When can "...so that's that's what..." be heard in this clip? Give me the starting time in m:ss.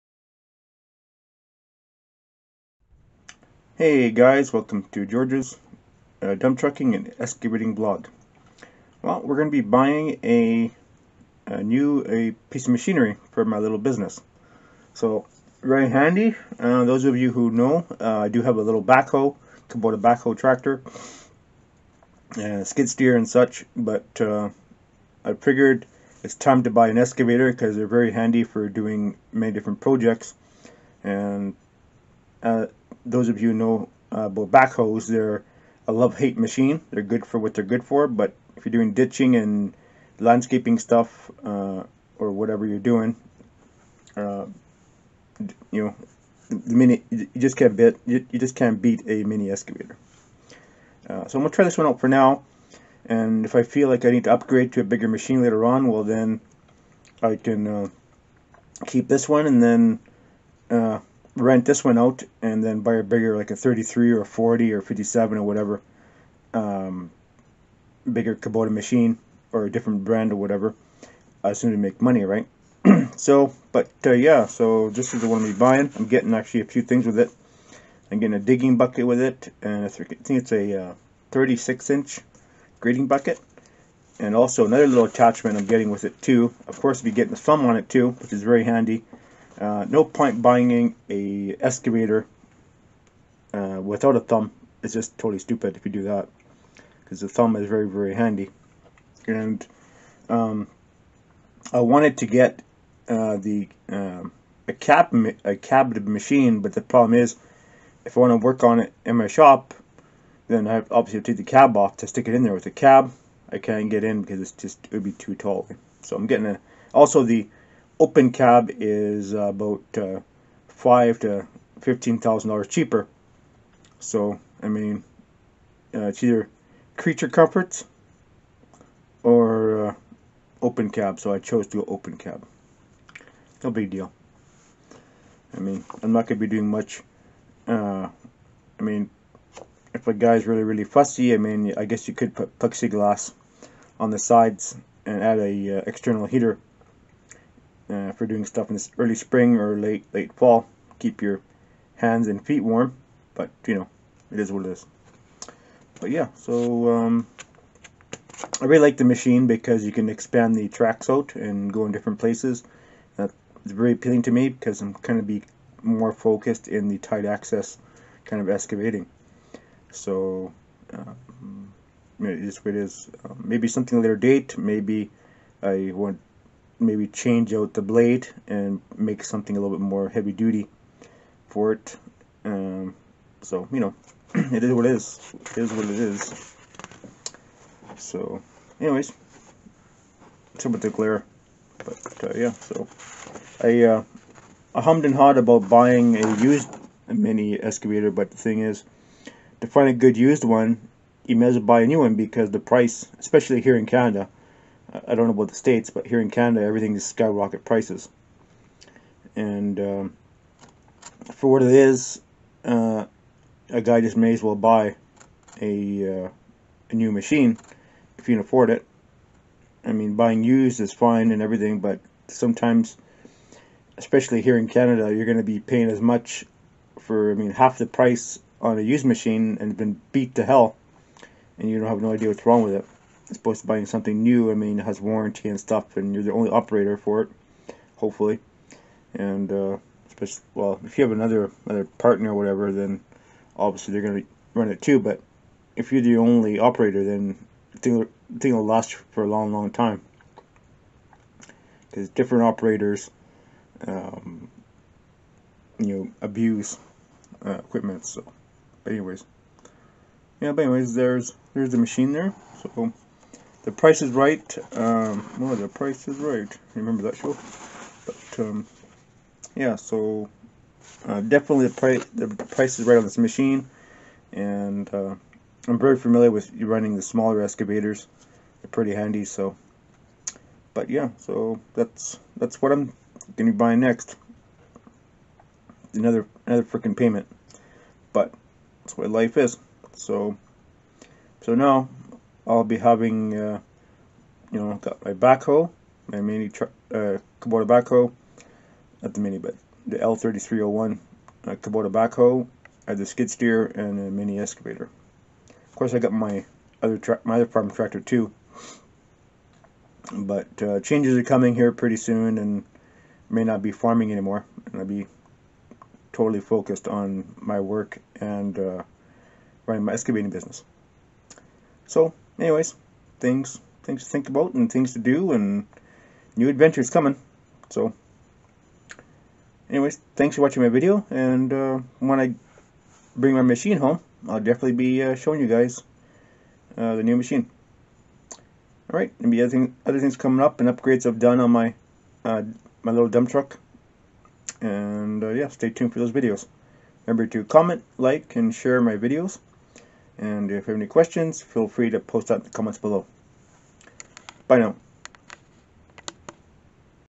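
4:41.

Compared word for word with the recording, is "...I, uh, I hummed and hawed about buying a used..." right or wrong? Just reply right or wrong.
right.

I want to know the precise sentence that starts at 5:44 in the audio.
And uh, yeah, stay tuned for those videos.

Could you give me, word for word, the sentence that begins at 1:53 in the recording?
I can't get in because it's just it would be too tall.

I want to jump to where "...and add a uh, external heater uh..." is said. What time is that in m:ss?
2:25.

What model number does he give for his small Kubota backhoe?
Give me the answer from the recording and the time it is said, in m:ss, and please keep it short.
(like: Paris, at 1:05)
L3301, at 4:59.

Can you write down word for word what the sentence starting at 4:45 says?
Another another freaking payment, but that's what life is.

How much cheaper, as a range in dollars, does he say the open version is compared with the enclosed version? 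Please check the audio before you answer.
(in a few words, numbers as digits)
$5,000 to $15,000.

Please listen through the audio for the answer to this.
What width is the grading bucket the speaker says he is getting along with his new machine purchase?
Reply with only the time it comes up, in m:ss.
1:21.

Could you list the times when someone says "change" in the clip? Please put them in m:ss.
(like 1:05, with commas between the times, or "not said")
2:57, 5:10.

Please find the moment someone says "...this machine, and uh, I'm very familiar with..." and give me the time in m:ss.
4:33.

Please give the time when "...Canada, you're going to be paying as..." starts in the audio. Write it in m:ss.
3:44.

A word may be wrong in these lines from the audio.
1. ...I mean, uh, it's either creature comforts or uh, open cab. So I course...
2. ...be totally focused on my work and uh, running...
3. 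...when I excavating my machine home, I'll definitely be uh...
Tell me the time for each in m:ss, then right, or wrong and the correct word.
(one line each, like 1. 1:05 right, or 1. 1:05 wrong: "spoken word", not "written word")
1. 2:04 wrong: "chose", not "course"
2. 5:14 right
3. 5:31 wrong: "bring", not "excavating".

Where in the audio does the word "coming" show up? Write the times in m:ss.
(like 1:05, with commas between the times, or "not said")
5:11, 5:26, 5:40.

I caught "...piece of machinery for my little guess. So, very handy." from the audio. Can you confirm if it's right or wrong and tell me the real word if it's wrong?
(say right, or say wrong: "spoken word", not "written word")
wrong: "business", not "guess".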